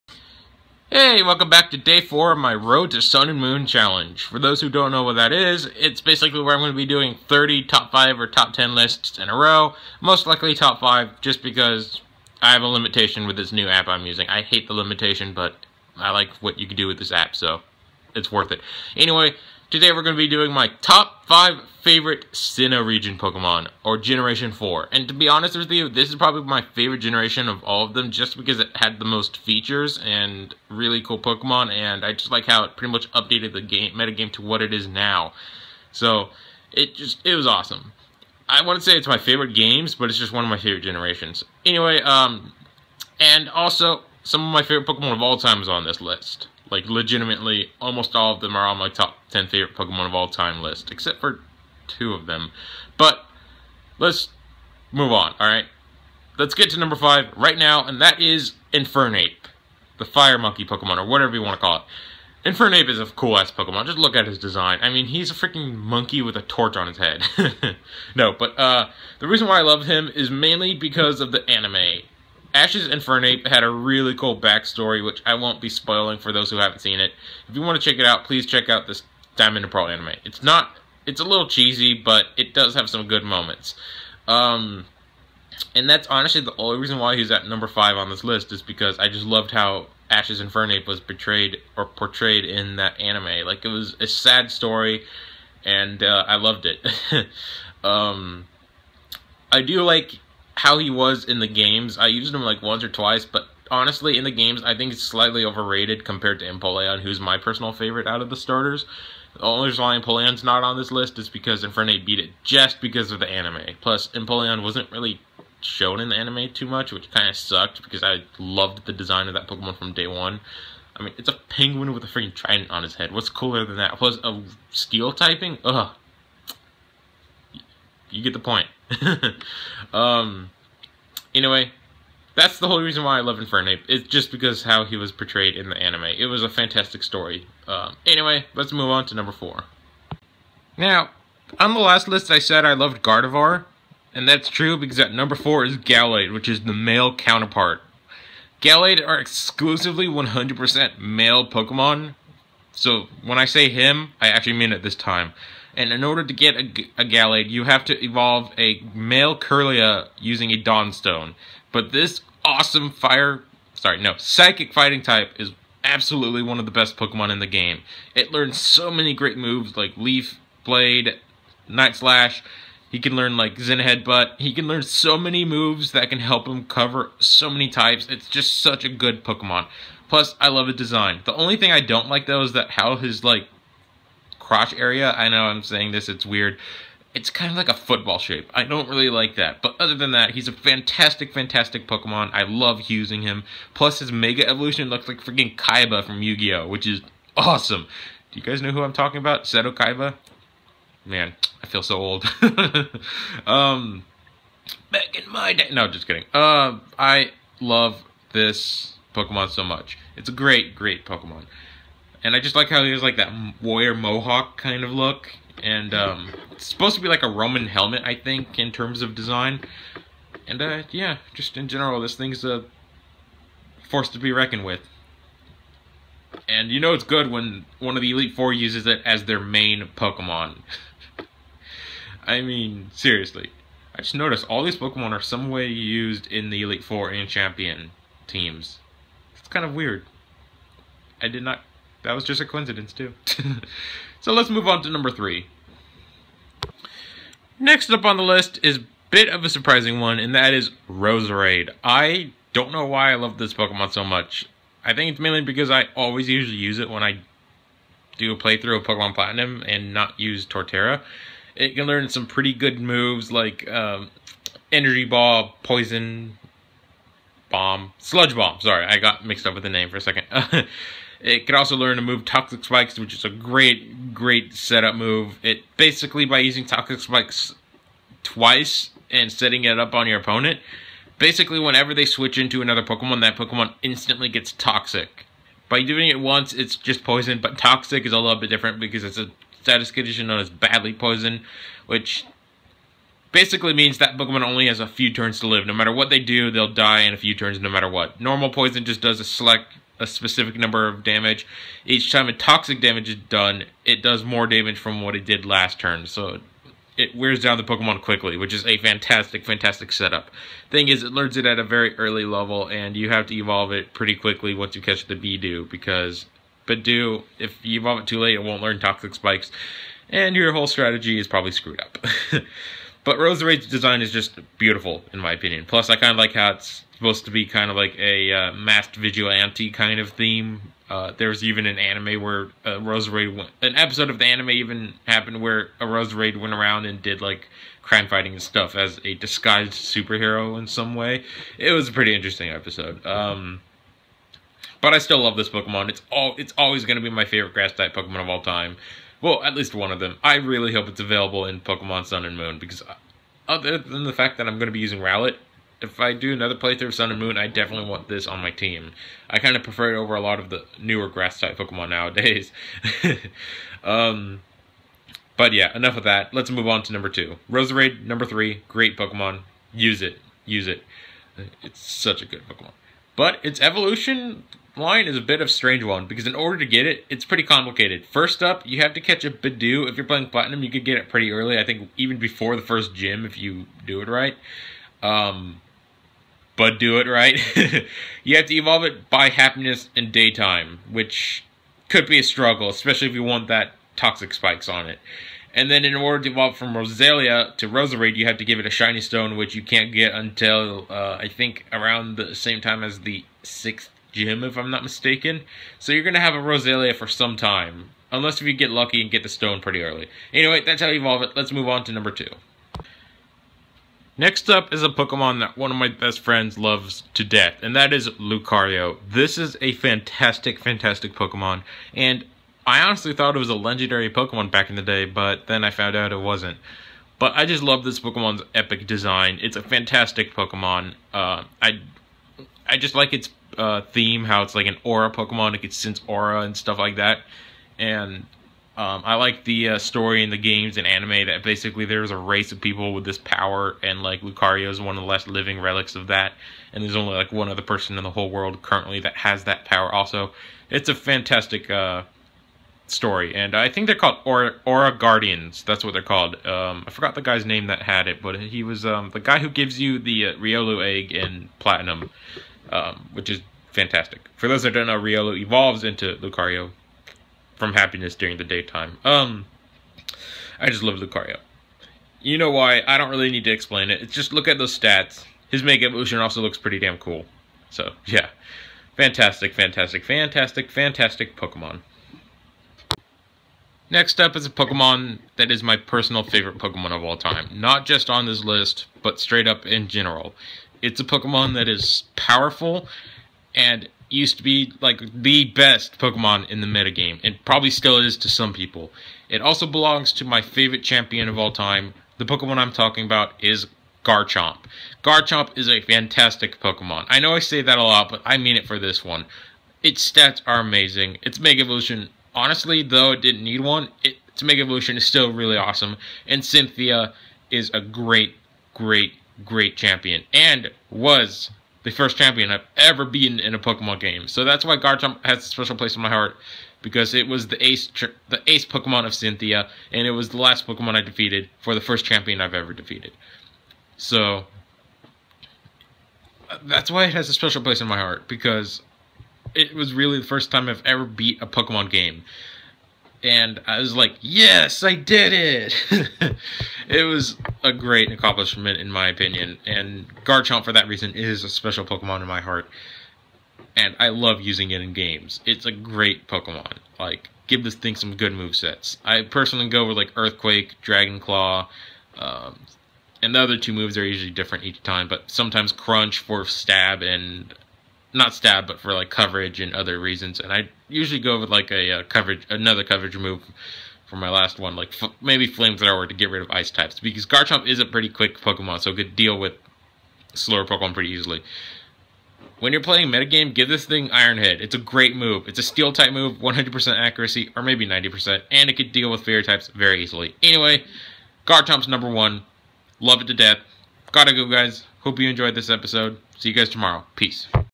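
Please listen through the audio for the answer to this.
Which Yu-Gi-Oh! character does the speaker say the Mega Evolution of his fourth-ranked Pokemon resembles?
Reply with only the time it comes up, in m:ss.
3:19.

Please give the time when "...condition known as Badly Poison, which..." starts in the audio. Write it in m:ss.
4:49.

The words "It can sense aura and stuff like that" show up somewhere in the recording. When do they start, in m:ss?
7:15.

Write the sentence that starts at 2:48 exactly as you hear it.
It learns so many great moves like Leaf, Blade, Night Slash.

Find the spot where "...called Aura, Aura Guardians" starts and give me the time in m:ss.
7:33.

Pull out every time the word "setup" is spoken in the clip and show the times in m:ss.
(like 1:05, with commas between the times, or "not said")
4:34, 5:09.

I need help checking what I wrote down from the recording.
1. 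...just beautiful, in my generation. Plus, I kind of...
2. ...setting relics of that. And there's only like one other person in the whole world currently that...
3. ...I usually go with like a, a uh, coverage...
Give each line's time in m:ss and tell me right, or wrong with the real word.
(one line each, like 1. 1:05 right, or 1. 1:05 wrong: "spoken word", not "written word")
1. 5:24 wrong: "opinion", not "generation"
2. 7:25 wrong: "living", not "setting"
3. 9:30 right.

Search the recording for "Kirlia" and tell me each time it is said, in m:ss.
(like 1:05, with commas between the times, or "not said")
2:39.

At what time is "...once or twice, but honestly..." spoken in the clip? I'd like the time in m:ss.
1:42.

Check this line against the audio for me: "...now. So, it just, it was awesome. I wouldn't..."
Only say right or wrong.
right.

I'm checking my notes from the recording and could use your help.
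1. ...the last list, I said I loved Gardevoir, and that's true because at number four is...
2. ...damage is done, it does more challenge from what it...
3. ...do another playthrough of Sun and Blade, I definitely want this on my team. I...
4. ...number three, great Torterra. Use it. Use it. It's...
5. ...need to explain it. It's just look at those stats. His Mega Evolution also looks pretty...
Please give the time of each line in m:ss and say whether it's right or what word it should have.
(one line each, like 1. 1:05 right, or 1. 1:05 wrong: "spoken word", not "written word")
1. 2:21 right
2. 5:02 wrong: "damage", not "challenge"
3. 5:56 wrong: "Moon", not "Blade"
4. 6:08 wrong: "Pokemon", not "Torterra"
5. 7:53 right.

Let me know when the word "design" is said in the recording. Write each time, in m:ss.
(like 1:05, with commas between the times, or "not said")
1:04, 1:58, 3:00, 3:39, 5:23, 7:08.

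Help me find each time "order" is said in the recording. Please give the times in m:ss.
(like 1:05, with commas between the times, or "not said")
2:36, 6:16, 6:35.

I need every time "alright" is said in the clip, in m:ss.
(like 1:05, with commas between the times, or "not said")
0:55.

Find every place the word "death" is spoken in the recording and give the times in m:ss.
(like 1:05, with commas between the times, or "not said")
6:57, 9:53.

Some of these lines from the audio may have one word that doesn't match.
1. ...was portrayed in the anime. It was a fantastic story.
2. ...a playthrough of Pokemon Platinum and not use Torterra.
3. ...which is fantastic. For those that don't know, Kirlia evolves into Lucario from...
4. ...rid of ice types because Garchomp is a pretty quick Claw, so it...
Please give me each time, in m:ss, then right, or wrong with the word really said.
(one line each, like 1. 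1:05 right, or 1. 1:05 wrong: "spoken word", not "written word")
1. 2:14 right
2. 4:18 right
3. 7:43 wrong: "Riolu", not "Kirlia"
4. 9:36 wrong: "Pokemon", not "Claw".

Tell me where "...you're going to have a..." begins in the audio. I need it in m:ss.
6:45.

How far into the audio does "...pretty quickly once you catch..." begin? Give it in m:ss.
5:13.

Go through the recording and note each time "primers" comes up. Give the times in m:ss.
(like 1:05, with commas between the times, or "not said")
not said.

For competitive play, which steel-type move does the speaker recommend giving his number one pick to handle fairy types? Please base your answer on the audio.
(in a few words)
Iron Head.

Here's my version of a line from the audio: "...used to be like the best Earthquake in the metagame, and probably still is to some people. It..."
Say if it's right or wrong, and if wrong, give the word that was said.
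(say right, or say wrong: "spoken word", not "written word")
wrong: "Pokemon", not "Earthquake".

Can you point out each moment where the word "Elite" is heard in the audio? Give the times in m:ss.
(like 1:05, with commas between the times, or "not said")
3:48, 3:56.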